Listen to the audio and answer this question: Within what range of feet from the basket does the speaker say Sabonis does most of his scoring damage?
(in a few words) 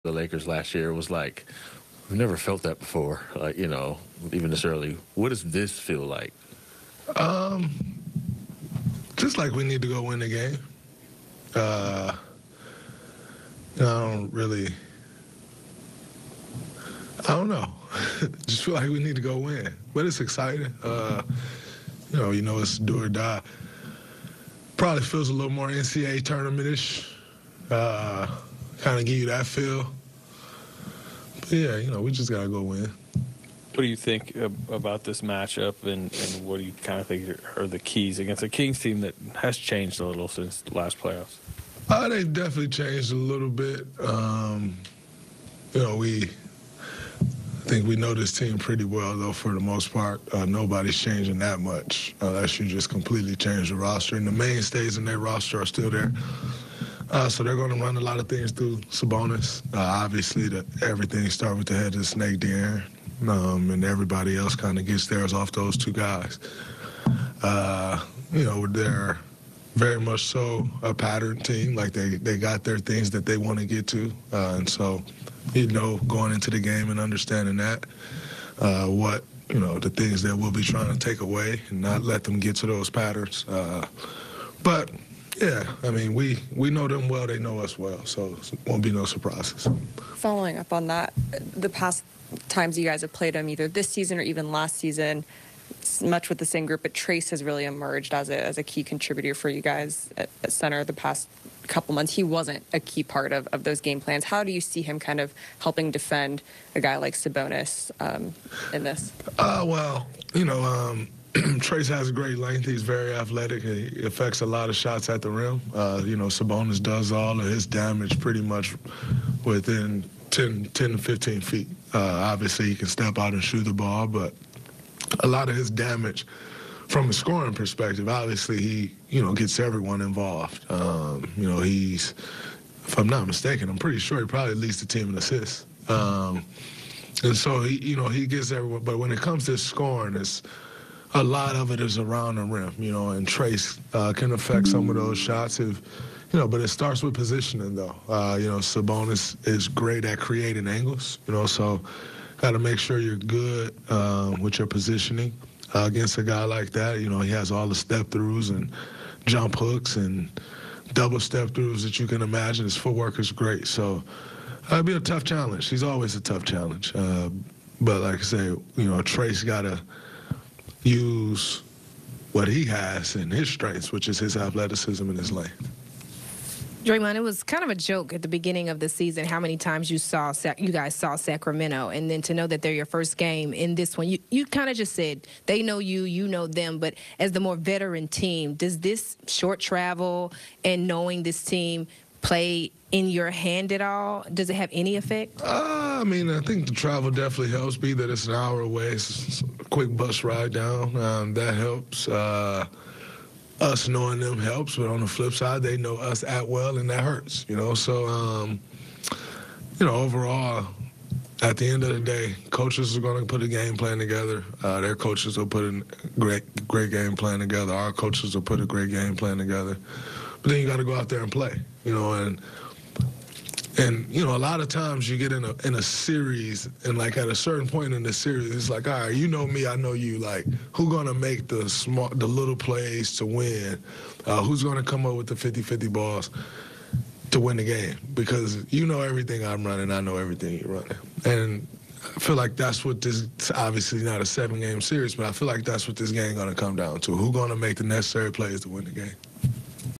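10 to 15 feet.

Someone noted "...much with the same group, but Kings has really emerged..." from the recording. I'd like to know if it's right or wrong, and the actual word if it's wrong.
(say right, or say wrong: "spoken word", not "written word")
wrong: "Trayce", not "Kings".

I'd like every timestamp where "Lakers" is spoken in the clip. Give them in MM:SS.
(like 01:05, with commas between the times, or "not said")
00:00.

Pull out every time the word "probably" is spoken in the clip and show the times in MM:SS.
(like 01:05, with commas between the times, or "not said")
00:24, 02:14.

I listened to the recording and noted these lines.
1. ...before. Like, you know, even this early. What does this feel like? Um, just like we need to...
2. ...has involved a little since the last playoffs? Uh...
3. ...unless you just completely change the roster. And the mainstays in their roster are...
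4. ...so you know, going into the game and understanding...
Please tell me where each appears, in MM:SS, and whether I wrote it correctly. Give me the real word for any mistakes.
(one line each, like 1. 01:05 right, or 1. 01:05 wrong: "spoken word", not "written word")
1. 00:02 right
2. 00:39 wrong: "changed", not "involved"
3. 00:52 right
4. 01:14 right.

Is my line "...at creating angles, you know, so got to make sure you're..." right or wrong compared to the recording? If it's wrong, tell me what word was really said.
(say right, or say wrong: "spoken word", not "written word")
right.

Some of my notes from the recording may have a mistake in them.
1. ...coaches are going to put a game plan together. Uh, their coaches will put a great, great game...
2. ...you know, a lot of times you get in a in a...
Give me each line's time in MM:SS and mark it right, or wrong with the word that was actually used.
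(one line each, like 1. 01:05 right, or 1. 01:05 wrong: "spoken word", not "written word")
1. 03:32 right
2. 03:44 right.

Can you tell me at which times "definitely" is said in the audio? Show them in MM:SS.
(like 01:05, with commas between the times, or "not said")
00:42, 03:17.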